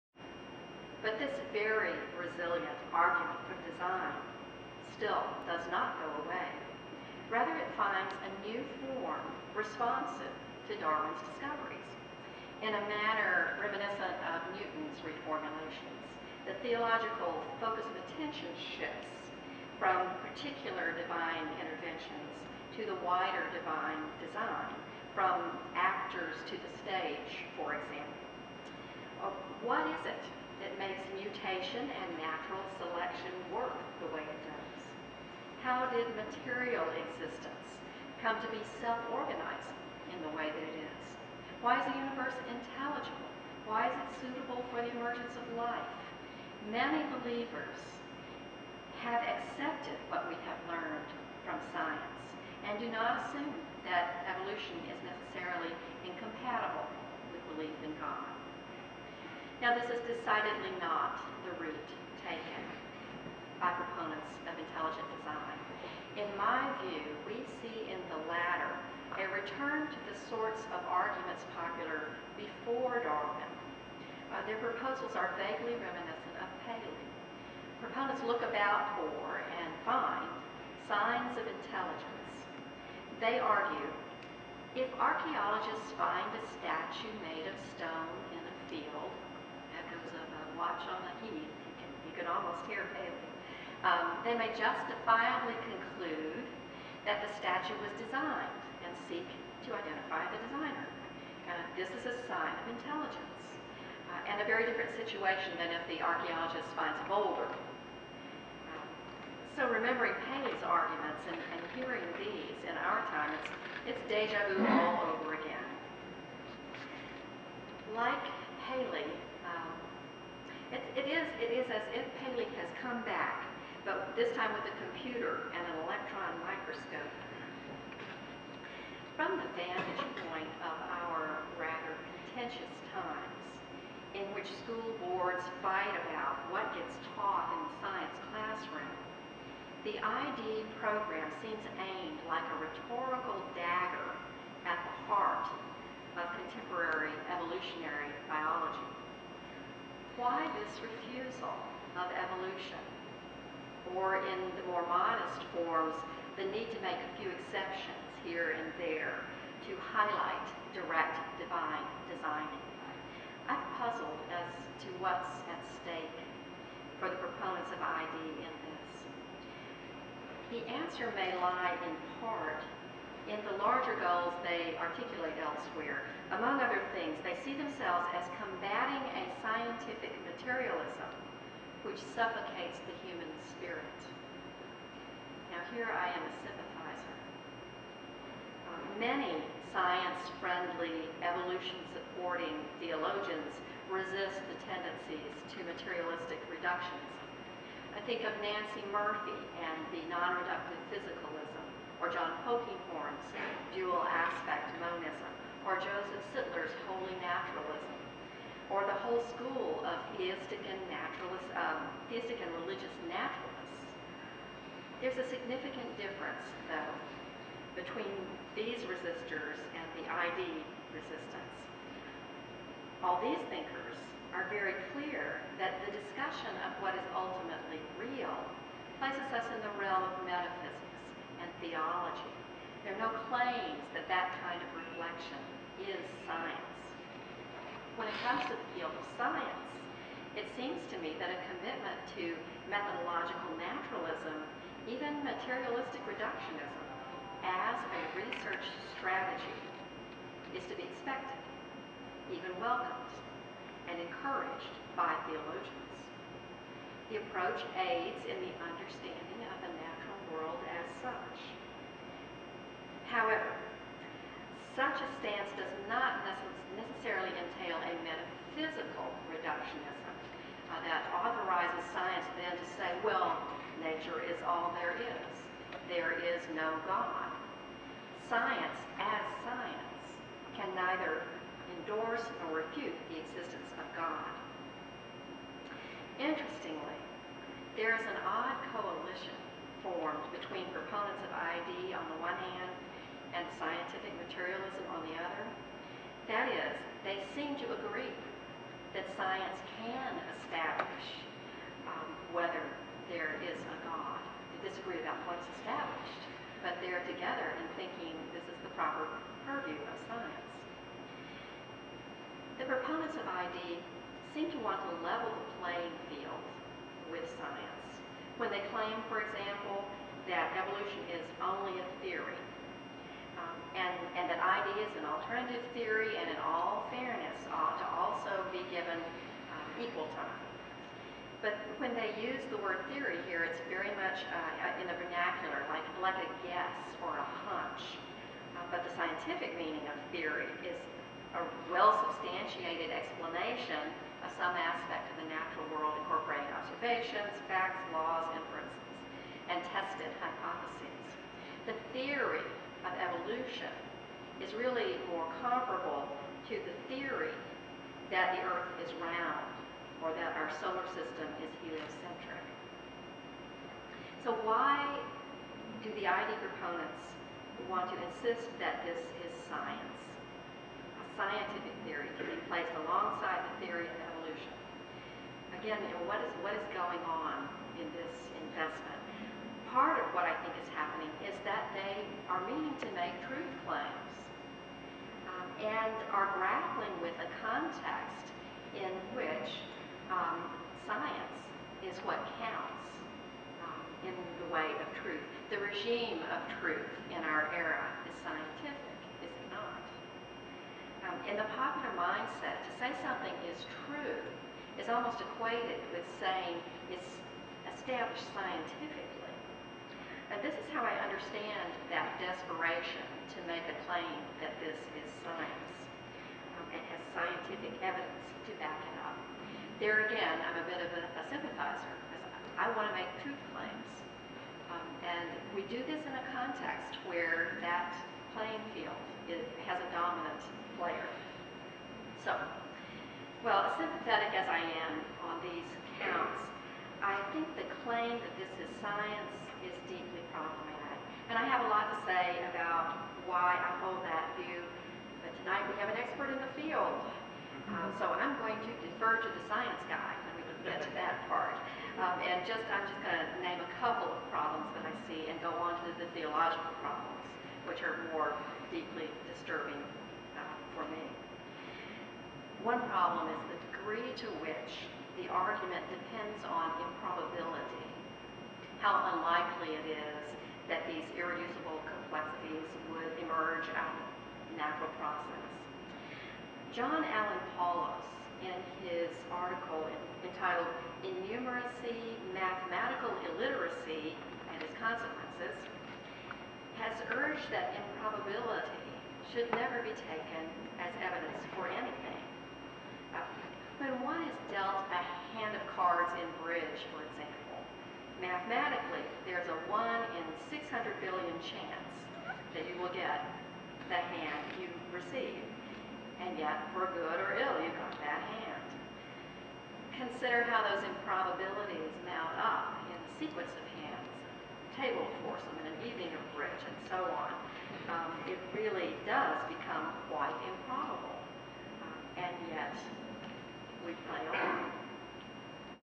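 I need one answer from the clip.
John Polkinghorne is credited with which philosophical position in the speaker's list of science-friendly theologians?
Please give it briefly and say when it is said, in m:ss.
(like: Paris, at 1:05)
dual aspect monism, at 3:23.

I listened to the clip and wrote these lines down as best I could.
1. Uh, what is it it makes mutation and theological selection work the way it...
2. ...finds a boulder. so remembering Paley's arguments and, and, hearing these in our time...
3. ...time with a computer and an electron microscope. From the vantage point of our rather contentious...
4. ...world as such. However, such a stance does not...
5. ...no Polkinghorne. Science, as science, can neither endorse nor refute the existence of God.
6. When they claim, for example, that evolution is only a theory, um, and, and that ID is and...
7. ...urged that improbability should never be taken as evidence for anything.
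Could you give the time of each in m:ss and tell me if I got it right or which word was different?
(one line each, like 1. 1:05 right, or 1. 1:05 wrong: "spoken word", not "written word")
1. 0:29 wrong: "natural", not "theological"
2. 1:46 right
3. 2:04 right
4. 4:20 right
5. 4:36 wrong: "God", not "Polkinghorne"
6. 5:18 right
7. 8:07 right.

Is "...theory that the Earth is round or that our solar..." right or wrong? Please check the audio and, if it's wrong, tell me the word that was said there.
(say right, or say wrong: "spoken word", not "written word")
right.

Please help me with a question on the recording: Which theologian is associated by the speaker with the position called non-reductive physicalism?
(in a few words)
Nancy Murphy.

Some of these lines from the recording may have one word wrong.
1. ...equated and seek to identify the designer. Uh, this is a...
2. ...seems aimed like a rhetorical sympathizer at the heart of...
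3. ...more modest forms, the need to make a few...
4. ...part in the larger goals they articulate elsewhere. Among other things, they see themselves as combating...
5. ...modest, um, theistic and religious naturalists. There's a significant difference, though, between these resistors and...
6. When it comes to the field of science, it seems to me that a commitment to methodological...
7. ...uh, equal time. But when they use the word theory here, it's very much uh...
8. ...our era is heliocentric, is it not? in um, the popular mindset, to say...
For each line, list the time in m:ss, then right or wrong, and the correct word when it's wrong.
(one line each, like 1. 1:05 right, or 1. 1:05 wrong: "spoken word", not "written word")
1. 1:37 wrong: "designed", not "equated"
2. 2:21 wrong: "dagger", not "sympathizer"
3. 2:34 right
4. 2:52 right
5. 3:30 wrong: "naturalist", not "modest"
6. 3:57 right
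7. 5:28 right
8. 6:37 wrong: "scientific", not "heliocentric".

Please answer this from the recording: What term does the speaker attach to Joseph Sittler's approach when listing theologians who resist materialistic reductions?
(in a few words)
holy naturalism.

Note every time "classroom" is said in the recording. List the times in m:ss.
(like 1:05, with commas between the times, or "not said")
2:18.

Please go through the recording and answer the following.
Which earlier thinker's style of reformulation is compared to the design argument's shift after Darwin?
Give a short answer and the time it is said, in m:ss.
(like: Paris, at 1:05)
Newton, at 0:14.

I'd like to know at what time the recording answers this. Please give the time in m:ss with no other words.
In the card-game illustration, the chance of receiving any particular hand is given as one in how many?
8:20.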